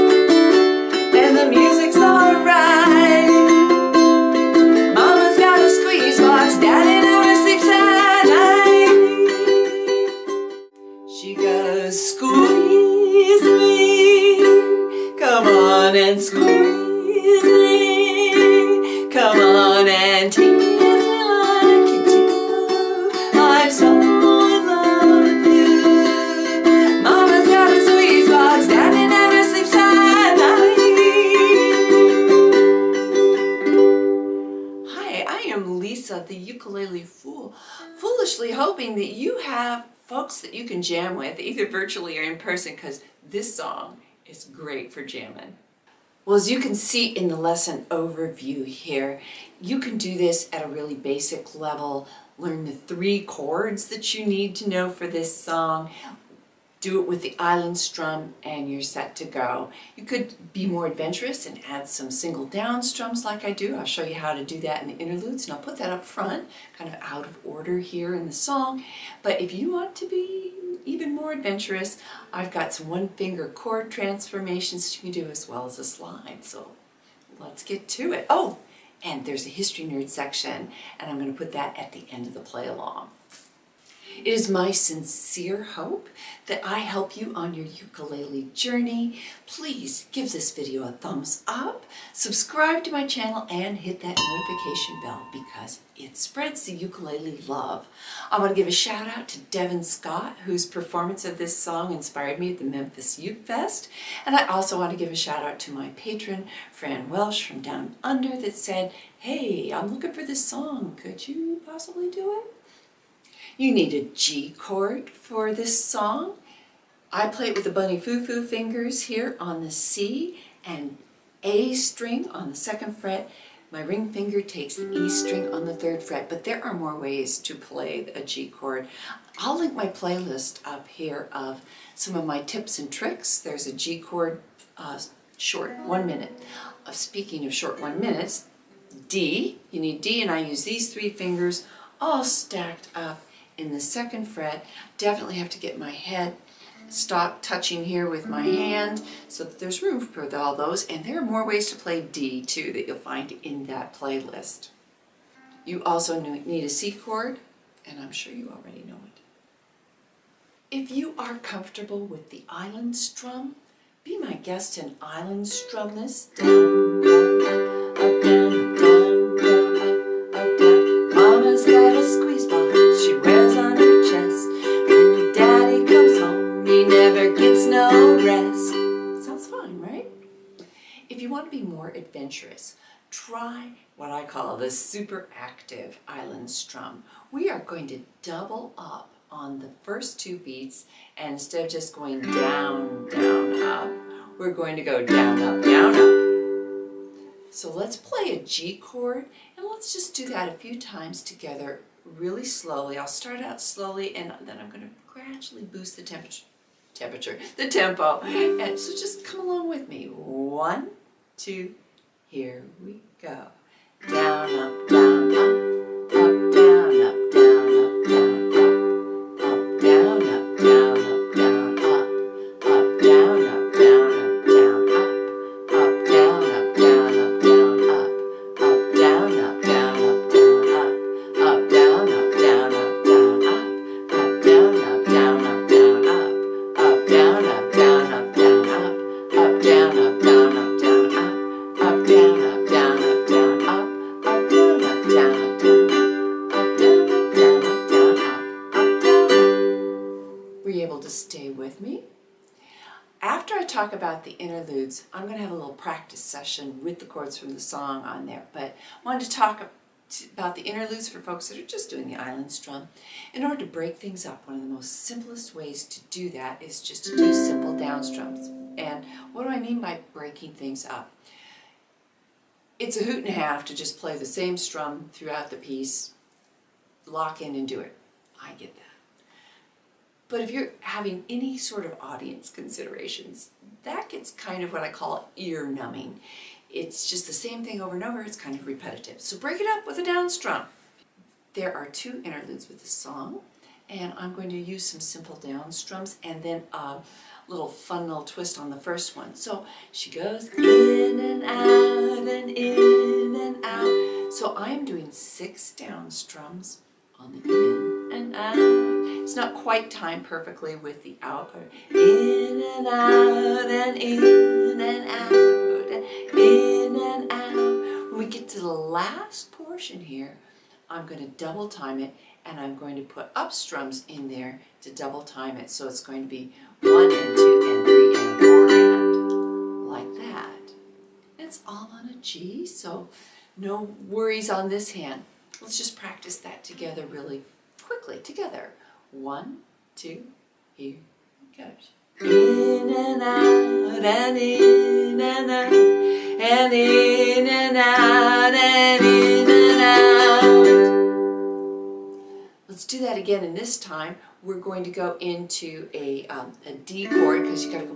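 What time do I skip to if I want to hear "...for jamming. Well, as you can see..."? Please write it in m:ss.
0:44.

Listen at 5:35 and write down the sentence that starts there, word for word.
Let's just practice that together really quickly, together.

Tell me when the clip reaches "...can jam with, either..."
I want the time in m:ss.
0:40.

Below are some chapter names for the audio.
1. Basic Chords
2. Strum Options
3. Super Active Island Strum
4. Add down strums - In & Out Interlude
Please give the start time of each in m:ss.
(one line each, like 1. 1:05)
1. 1:54
2. 2:40
3. 3:04
4. 4:22.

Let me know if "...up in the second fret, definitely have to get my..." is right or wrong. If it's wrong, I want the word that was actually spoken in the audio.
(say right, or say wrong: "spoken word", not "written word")
right.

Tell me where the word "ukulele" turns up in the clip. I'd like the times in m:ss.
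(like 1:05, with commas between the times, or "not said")
1:27, 1:36.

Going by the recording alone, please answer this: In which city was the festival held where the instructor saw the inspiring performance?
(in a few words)
Memphis.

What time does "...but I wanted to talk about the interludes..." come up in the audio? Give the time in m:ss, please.
4:18.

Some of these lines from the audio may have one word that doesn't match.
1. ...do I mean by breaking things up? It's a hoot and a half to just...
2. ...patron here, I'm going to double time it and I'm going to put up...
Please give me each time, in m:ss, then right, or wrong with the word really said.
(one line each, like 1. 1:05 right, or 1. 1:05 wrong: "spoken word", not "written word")
1. 4:29 right
2. 5:19 wrong: "portion", not "patron".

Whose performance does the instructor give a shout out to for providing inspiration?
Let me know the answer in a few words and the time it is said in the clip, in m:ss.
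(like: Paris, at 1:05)
Devin Scott, at 1:39.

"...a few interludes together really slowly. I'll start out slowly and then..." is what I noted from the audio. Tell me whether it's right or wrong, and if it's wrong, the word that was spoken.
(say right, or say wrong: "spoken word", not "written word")
wrong: "times", not "interludes".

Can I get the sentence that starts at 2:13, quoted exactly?
There's a G chord uh, short, one minute.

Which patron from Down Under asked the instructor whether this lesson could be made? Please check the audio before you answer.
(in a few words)
Fran Welsh.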